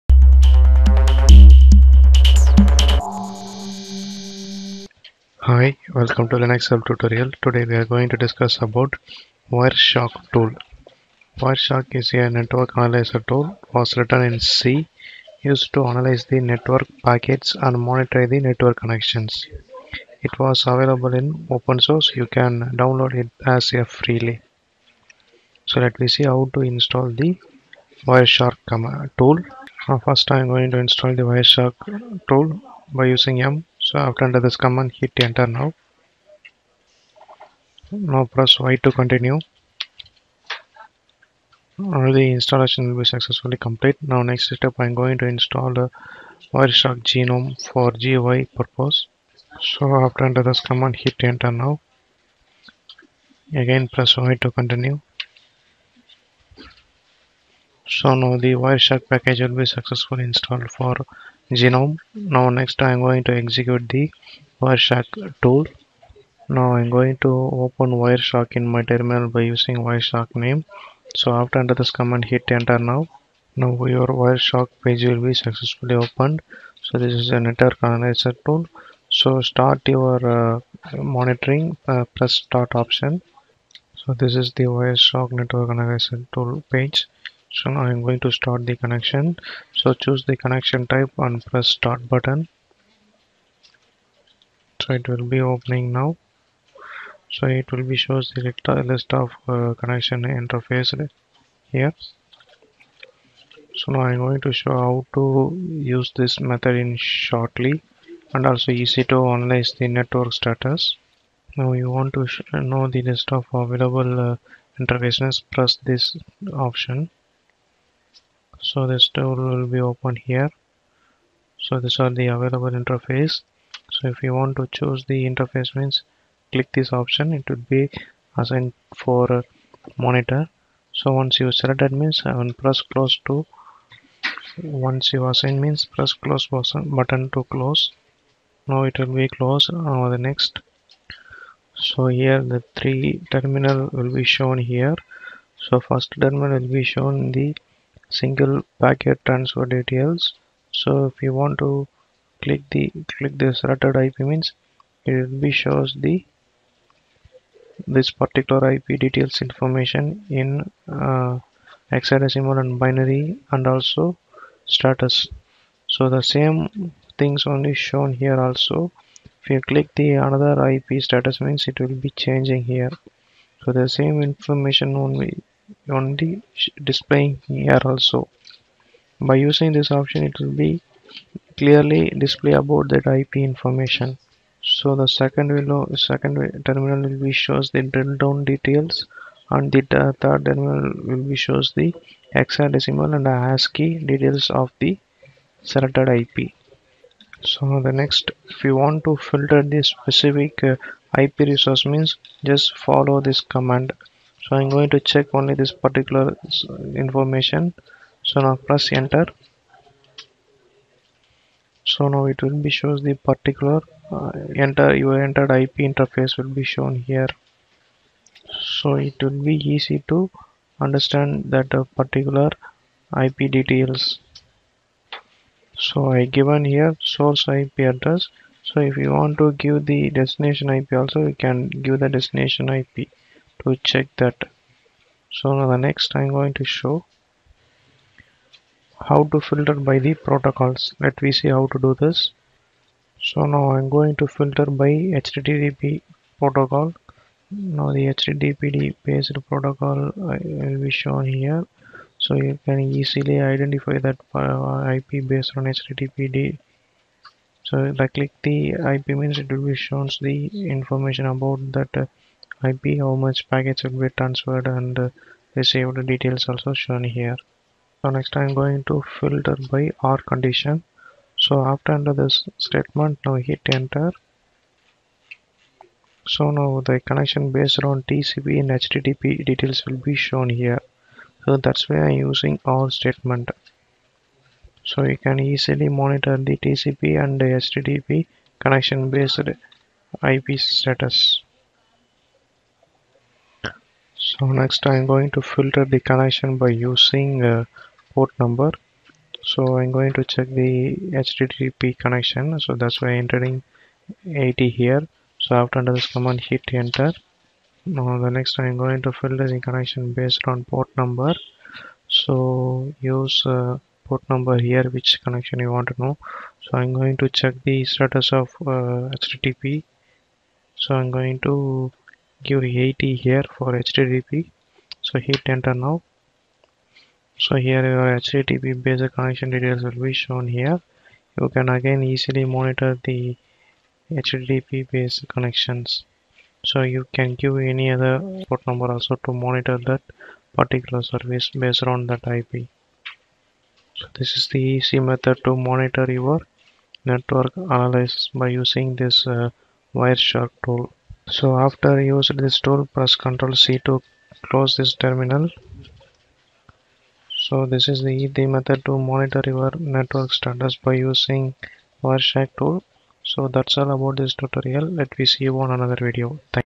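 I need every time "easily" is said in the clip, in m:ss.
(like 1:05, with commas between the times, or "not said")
4:12, 4:45, 5:32.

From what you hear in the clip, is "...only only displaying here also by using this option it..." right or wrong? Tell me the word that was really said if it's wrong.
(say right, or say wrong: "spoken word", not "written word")
right.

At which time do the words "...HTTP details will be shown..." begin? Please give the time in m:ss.
4:38.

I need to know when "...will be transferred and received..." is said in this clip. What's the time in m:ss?
4:23.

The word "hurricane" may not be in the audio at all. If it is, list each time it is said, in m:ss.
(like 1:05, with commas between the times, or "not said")
not said.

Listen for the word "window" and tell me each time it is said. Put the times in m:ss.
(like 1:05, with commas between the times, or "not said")
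3:05.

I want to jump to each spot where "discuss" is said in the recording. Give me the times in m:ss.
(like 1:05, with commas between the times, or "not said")
0:08.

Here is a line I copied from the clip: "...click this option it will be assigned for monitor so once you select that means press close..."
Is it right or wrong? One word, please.
right.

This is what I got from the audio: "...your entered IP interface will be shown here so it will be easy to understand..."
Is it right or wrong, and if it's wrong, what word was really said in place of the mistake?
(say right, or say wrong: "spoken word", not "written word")
right.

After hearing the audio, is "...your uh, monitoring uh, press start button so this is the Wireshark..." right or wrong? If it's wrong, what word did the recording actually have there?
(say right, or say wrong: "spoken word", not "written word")
wrong: "option", not "button".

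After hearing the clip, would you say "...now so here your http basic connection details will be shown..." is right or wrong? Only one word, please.
right.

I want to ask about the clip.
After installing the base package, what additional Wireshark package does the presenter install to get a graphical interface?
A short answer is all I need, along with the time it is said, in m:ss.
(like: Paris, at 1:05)
Wireshark gnome, at 0:46.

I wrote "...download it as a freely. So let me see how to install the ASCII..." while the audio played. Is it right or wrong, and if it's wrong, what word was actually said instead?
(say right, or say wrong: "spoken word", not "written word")
wrong: "Wireshark", not "ASCII".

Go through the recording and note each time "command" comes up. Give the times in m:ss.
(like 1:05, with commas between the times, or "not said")
0:34, 0:50, 1:11, 3:23, 5:06.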